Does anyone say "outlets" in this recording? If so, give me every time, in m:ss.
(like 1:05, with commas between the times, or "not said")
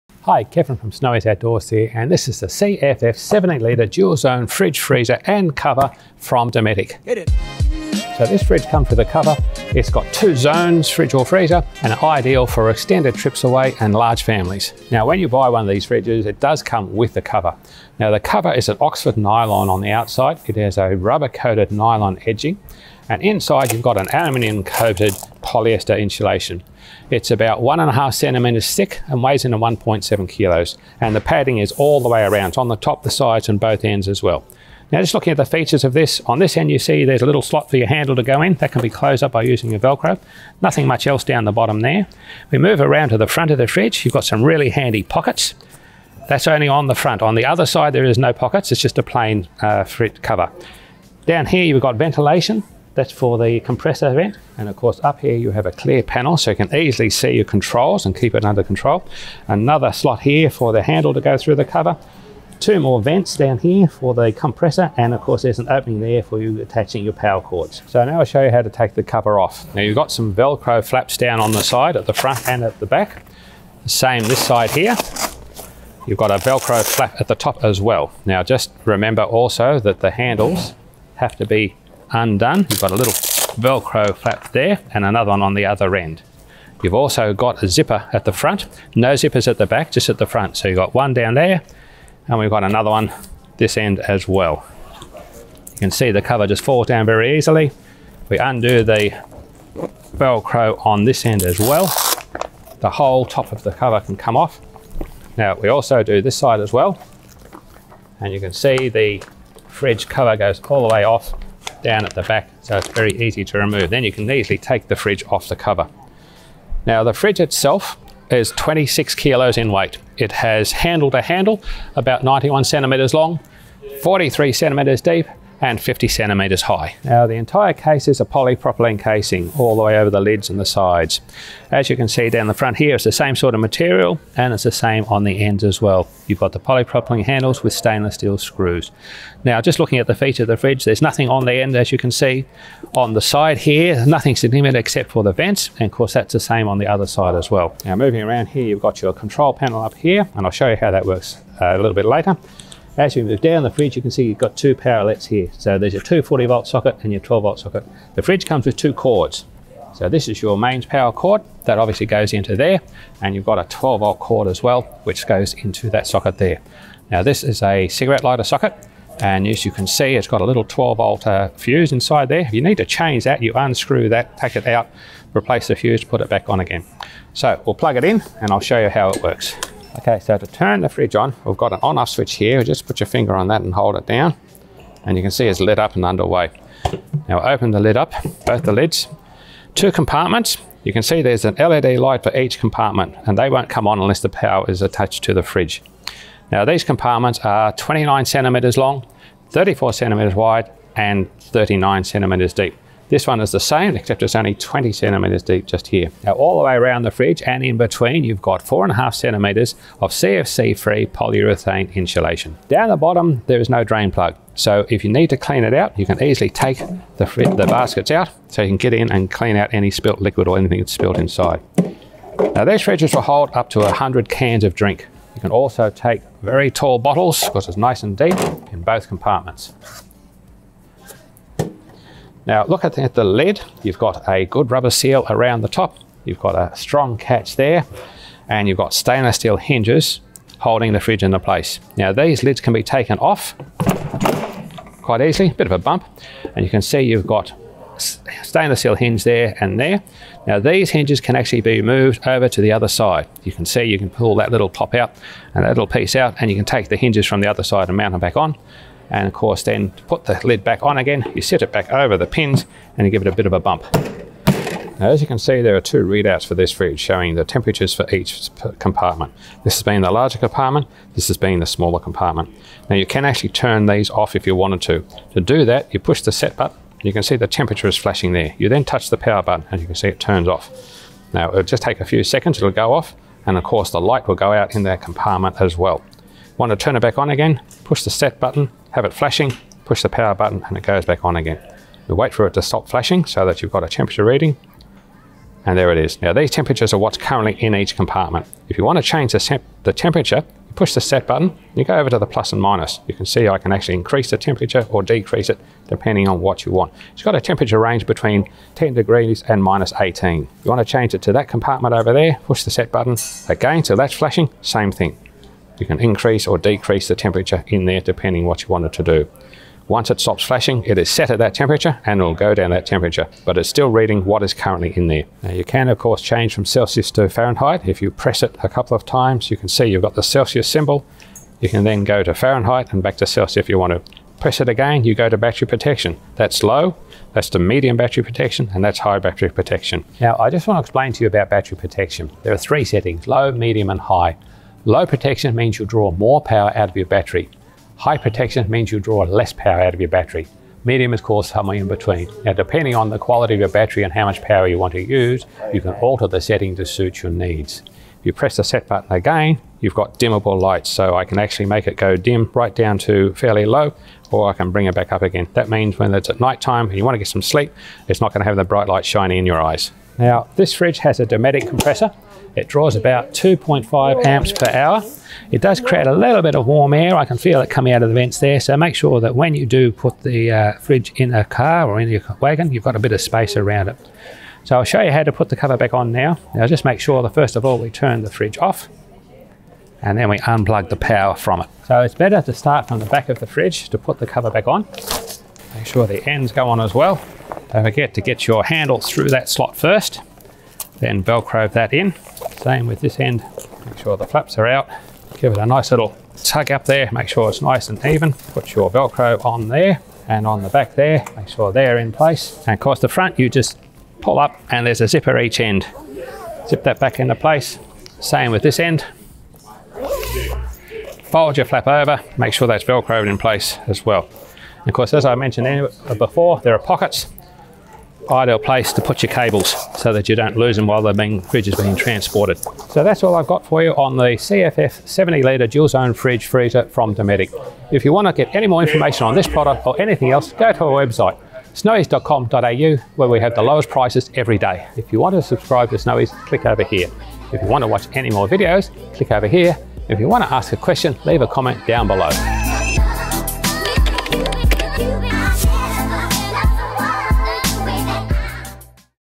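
2:34.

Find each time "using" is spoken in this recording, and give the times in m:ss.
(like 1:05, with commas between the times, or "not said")
0:39.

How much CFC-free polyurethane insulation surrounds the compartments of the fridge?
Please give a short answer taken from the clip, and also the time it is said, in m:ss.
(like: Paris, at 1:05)
4.5 centimetres, at 3:28.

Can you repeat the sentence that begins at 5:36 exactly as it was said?
That's low, that's the medium battery protection, and that's high battery protection.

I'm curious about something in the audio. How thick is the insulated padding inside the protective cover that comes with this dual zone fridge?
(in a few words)
1.5 centimetres.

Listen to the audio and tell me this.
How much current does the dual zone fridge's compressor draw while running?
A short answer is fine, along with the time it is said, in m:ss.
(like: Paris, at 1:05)
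2.5 amps per hour, at 6:13.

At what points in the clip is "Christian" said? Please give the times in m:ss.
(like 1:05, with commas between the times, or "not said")
not said.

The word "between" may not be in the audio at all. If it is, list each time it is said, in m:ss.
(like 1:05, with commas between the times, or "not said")
3:27, 5:08, 5:51.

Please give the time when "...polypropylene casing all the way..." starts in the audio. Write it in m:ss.
2:08.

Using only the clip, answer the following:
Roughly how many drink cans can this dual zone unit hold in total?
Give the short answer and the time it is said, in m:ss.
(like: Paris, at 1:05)
100, at 3:43.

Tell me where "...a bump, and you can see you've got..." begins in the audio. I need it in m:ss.
4:05.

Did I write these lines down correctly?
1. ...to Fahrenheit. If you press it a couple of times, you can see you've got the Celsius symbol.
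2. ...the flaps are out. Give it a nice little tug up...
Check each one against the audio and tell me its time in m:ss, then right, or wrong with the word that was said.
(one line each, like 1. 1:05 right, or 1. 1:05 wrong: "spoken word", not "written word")
1. 5:27 right
2. 6:44 right.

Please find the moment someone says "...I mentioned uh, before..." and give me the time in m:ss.
7:05.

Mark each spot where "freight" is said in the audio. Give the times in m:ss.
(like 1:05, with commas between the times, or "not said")
not said.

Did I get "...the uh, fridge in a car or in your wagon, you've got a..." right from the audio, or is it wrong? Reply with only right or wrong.
right.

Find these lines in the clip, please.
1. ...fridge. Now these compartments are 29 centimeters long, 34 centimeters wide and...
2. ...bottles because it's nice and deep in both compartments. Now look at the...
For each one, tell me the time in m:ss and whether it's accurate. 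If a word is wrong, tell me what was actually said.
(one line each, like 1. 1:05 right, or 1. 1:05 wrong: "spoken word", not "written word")
1. 3:15 right
2. 3:46 right.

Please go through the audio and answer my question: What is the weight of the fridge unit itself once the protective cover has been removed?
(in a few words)
26 kilos.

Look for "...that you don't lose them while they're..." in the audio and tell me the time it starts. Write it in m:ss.
7:10.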